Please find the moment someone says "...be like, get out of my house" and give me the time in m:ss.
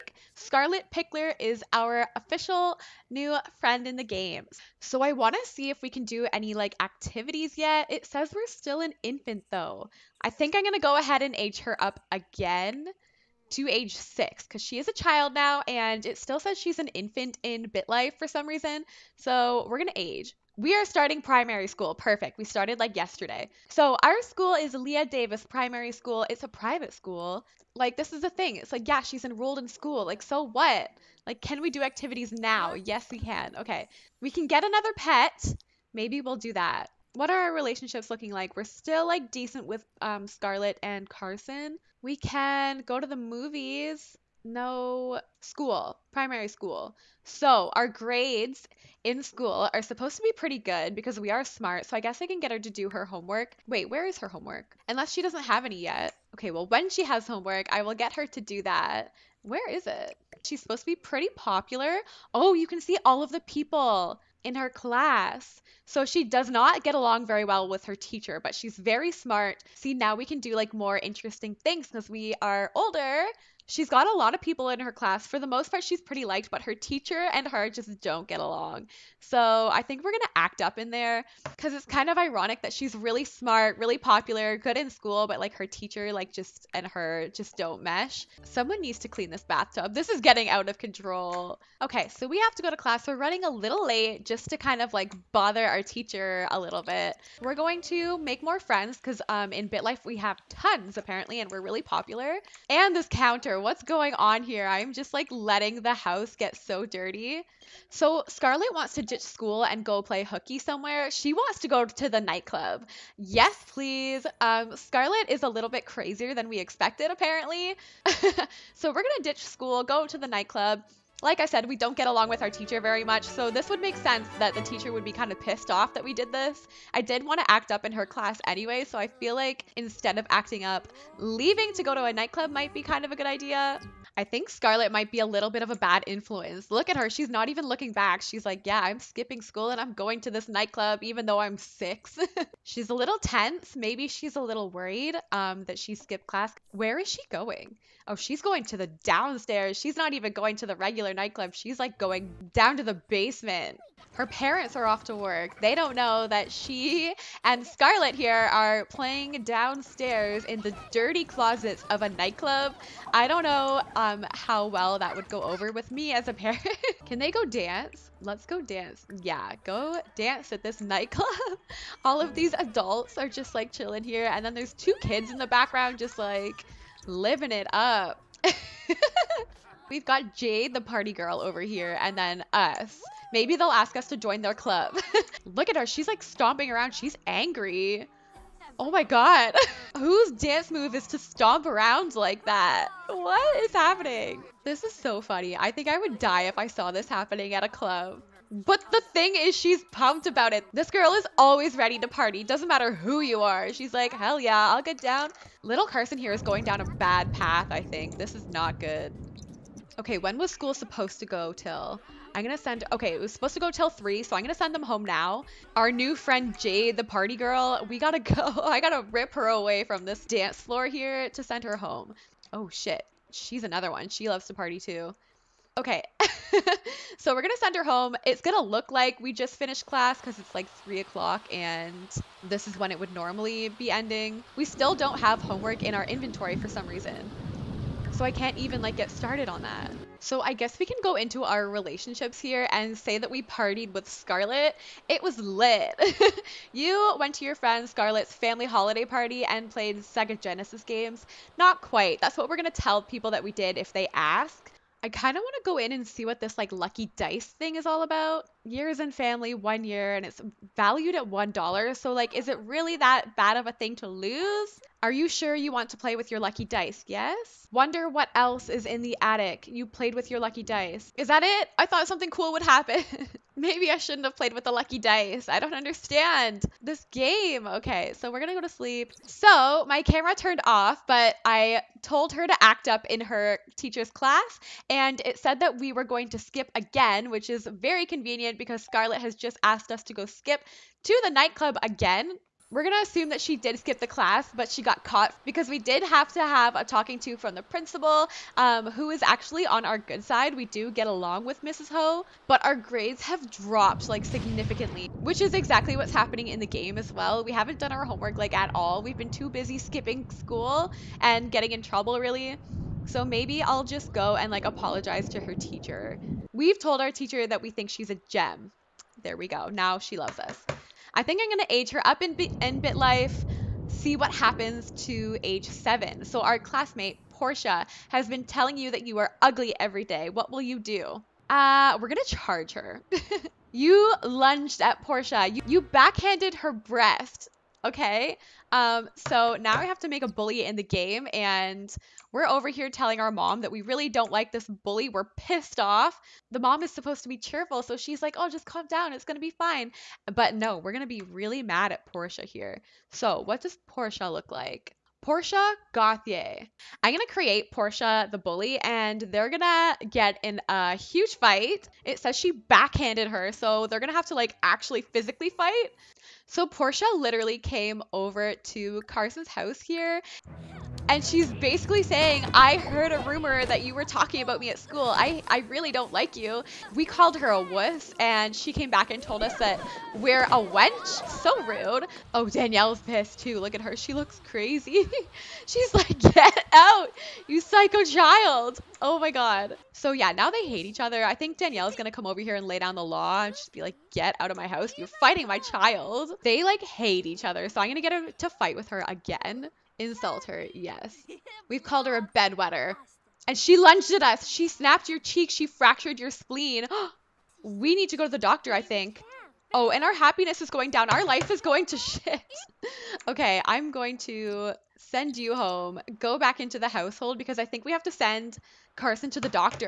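6:33.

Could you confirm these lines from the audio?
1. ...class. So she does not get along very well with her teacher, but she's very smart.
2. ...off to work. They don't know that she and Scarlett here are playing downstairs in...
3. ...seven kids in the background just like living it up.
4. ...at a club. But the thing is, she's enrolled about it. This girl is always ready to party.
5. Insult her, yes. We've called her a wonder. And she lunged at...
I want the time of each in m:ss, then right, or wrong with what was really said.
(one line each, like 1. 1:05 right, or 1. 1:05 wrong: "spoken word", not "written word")
1. 1:04 right
2. 2:34 right
3. 2:54 wrong: "two", not "seven"
4. 3:17 wrong: "pumped", not "enrolled"
5. 6:39 wrong: "bedwetter", not "wonder".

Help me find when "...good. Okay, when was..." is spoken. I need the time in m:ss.
3:28.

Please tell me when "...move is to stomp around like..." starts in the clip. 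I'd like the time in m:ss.
3:10.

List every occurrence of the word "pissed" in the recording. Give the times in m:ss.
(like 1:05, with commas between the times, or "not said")
2:05, 5:45, 6:22.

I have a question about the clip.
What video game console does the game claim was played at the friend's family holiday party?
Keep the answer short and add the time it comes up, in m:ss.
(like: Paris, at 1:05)
Sega Genesis, at 4:10.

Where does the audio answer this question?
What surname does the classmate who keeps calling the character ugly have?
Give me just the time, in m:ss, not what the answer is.
5:55.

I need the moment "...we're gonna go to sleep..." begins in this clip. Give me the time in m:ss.
4:38.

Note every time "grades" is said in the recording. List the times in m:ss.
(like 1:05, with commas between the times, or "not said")
0:47, 5:02.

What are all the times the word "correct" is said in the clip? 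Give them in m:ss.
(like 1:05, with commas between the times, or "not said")
not said.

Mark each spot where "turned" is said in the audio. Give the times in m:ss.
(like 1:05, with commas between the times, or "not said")
4:40.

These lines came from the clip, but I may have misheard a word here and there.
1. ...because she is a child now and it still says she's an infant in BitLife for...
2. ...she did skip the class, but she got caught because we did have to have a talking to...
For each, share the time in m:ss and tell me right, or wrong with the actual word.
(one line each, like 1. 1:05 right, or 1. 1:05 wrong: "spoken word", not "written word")
1. 0:14 right
2. 4:53 right.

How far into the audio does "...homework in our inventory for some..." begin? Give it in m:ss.
3:55.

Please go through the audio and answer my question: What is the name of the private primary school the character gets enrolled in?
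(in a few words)
Leah Davis Primary School.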